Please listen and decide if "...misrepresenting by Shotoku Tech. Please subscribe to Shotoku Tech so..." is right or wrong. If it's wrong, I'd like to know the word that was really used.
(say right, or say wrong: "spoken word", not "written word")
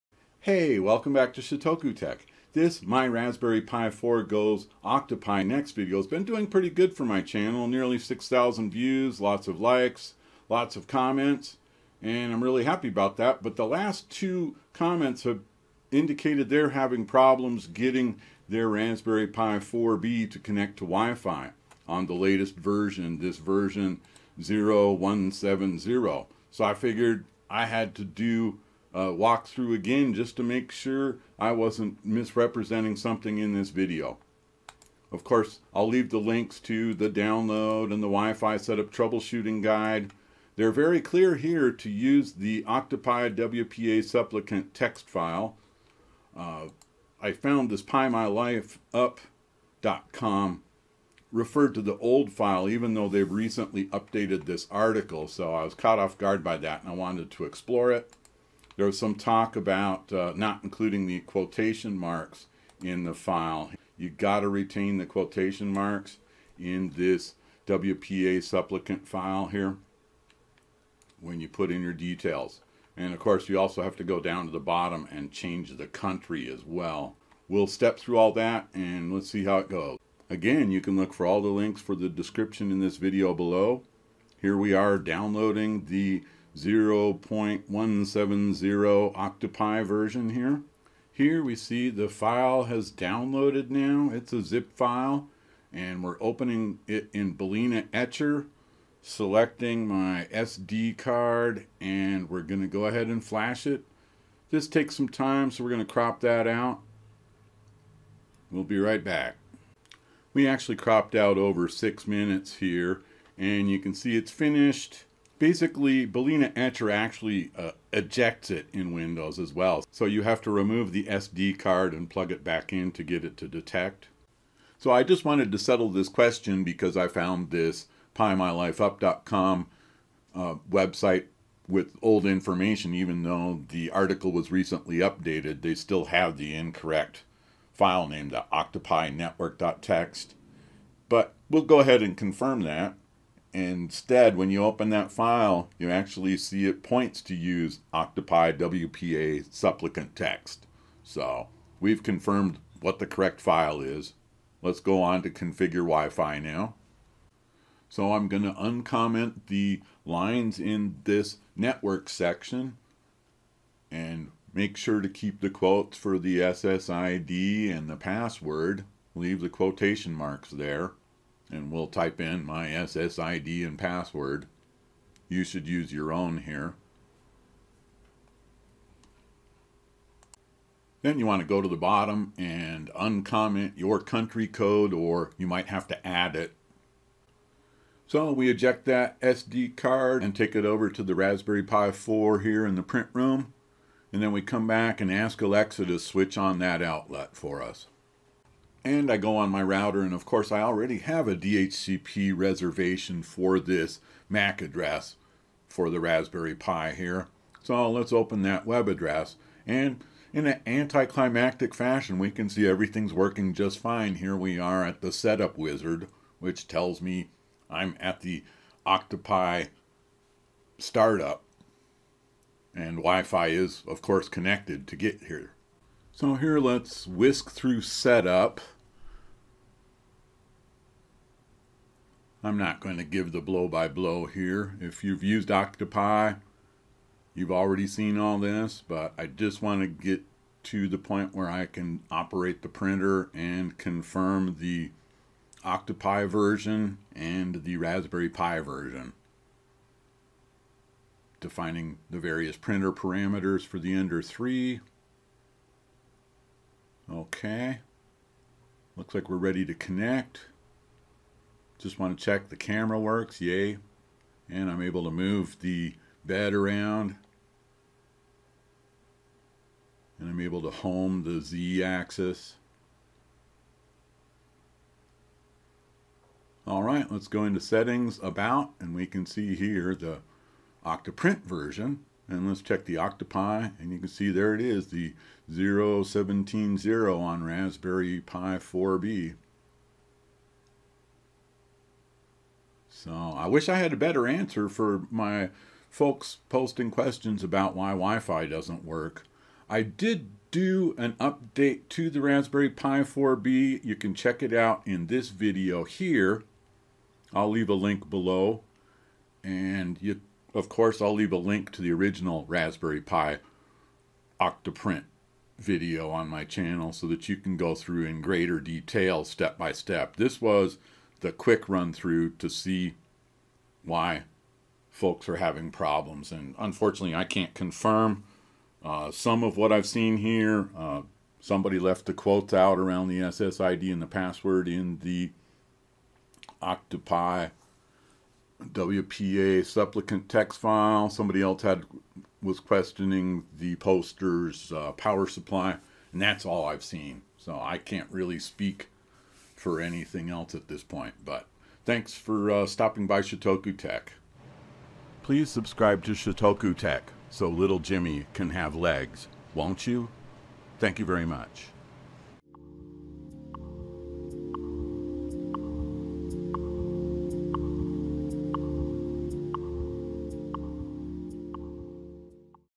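wrong: "stopping", not "misrepresenting".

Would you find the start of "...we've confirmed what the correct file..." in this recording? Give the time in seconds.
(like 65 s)
151 s.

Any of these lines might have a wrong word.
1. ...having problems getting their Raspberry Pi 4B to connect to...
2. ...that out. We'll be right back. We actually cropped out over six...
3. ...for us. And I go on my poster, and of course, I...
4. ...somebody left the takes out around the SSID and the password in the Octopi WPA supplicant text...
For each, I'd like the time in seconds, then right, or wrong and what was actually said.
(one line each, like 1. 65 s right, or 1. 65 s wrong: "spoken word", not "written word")
1. 16 s right
2. 106 s right
3. 197 s wrong: "router", not "poster"
4. 331 s wrong: "quotes", not "takes".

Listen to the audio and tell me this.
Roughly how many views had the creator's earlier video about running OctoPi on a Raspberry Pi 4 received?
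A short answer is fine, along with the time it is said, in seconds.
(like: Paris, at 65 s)
Nearly 6,000, at 7 s.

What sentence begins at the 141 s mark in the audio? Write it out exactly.
But we'll go ahead and confirm that.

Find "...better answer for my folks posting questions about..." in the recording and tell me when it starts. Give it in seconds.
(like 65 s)
293 s.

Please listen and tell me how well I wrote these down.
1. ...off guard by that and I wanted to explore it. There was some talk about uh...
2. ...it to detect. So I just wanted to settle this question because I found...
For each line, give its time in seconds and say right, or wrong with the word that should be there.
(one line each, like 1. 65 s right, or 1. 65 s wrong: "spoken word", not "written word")
1. 55 s right
2. 123 s right.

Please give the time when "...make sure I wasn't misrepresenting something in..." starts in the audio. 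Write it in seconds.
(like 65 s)
30 s.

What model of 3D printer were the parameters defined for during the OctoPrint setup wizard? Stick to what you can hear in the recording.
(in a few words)
Ender 3.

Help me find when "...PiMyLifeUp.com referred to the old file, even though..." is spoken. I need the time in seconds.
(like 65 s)
47 s.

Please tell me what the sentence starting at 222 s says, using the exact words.
And Wi-Fi is, of course, connected to get here.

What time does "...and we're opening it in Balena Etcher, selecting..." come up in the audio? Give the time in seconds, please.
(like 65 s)
95 s.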